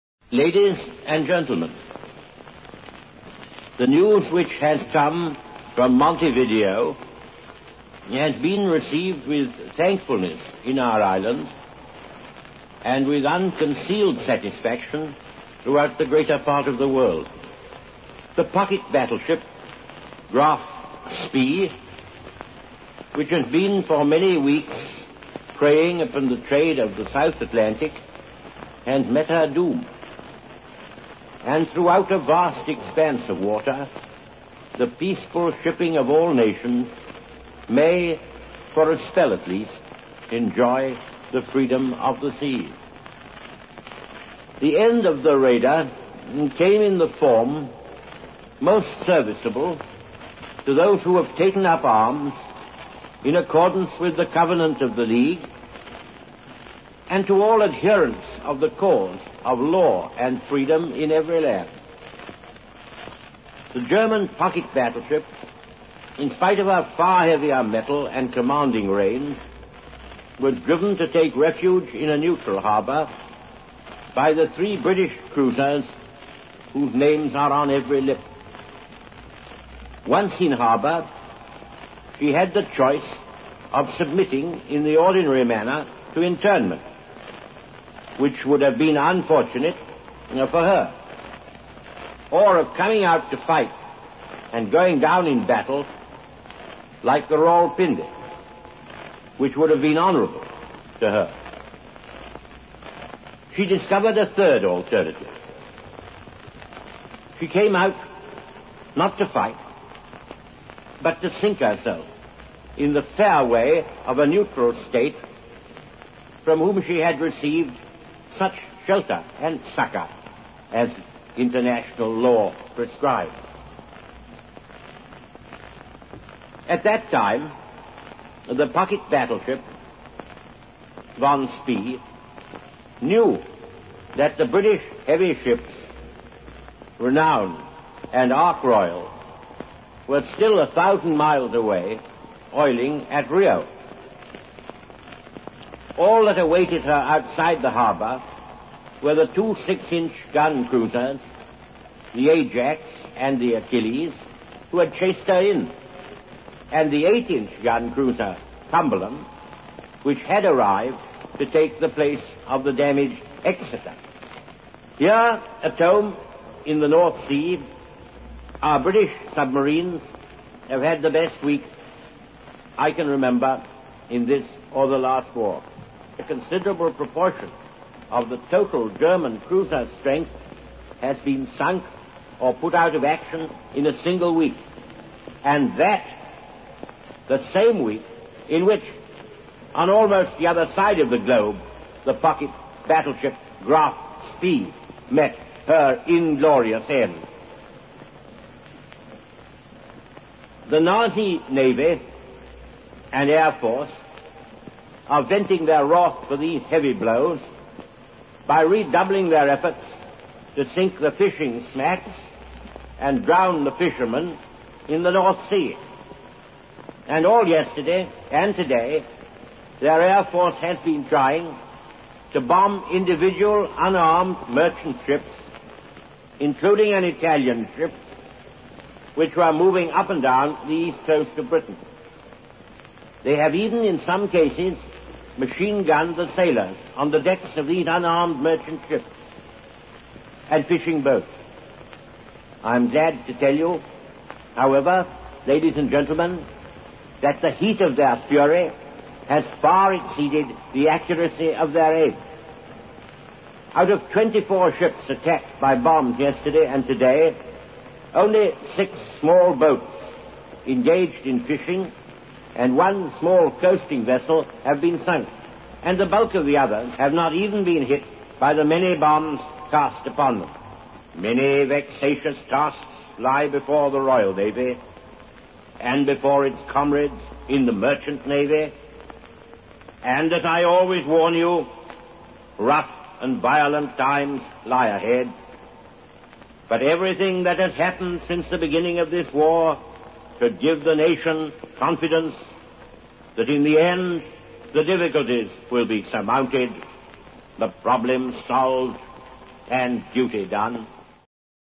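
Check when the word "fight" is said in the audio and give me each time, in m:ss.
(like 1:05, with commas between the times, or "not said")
1:33, 1:49.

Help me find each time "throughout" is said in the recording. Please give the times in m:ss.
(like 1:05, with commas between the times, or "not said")
0:15, 0:31.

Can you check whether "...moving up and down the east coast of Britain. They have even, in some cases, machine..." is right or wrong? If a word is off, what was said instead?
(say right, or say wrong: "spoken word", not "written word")
right.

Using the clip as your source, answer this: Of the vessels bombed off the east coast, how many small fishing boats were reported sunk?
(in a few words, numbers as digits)
6.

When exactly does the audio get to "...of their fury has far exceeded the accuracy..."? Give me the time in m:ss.
4:07.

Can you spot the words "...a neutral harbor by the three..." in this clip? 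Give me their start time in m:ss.
1:12.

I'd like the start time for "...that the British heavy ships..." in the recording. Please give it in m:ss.
2:14.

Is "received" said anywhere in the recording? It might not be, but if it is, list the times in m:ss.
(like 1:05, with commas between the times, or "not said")
0:08, 1:57.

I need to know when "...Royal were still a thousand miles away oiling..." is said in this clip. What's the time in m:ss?
2:18.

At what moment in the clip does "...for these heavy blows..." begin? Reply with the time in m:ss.
3:26.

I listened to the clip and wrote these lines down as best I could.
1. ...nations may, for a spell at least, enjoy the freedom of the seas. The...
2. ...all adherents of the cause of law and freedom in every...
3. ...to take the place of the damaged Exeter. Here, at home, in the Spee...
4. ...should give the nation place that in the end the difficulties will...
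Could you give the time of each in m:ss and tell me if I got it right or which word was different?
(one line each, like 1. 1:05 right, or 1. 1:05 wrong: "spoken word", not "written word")
1. 0:36 right
2. 0:57 right
3. 2:41 wrong: "North", not "Spee"
4. 4:50 wrong: "confidence", not "place".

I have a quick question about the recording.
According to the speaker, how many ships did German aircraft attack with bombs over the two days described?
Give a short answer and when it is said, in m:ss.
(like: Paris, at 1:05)
24, at 4:14.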